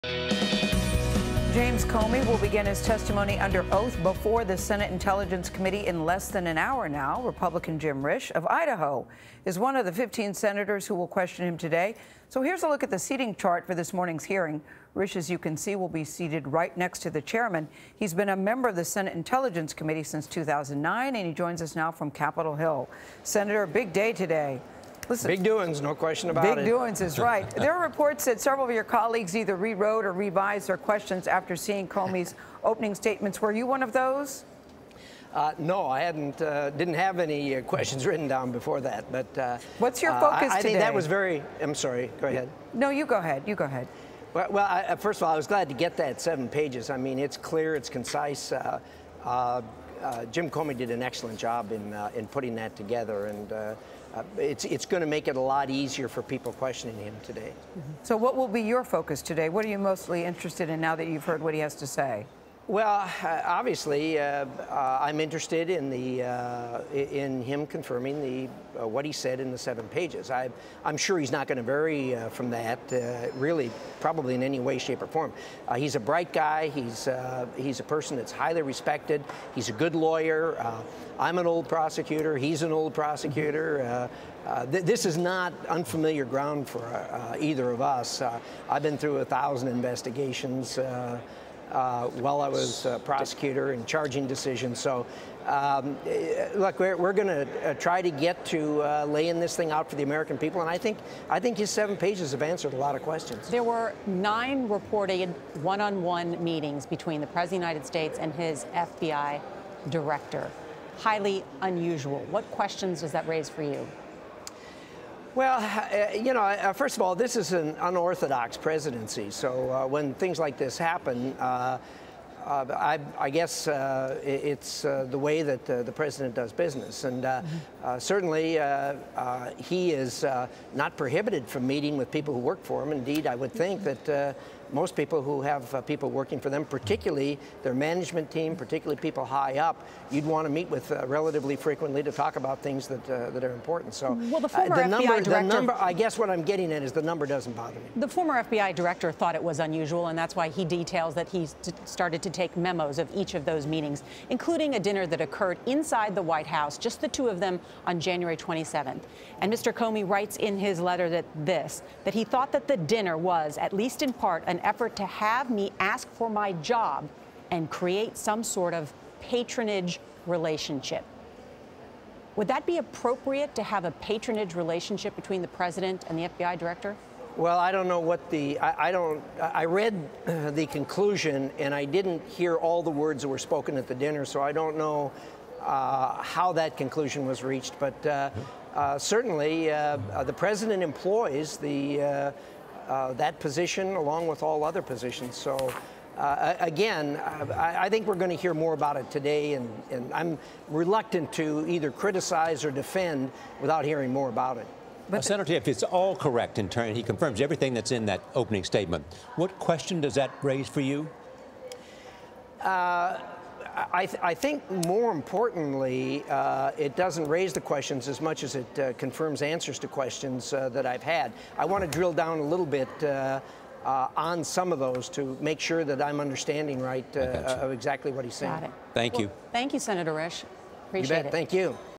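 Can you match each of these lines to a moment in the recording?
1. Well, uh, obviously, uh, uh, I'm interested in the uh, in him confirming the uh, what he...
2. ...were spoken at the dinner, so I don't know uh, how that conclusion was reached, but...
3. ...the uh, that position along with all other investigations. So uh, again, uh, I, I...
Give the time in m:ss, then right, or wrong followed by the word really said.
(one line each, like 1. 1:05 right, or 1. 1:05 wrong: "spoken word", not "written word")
1. 1:02 right
2. 3:03 right
3. 3:11 wrong: "positions", not "investigations".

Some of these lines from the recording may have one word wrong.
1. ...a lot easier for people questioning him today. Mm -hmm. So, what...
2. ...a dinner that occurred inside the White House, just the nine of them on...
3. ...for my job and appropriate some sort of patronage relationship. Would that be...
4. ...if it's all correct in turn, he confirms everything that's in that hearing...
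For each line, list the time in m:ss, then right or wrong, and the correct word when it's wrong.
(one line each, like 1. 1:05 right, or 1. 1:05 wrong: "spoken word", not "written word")
1. 0:55 right
2. 2:34 wrong: "two", not "nine"
3. 2:46 wrong: "create", not "appropriate"
4. 3:25 wrong: "opening", not "hearing".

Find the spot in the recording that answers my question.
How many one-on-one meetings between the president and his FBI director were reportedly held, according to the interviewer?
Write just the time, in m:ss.
1:44.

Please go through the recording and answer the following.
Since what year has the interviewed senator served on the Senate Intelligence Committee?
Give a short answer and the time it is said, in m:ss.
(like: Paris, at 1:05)
2009, at 0:20.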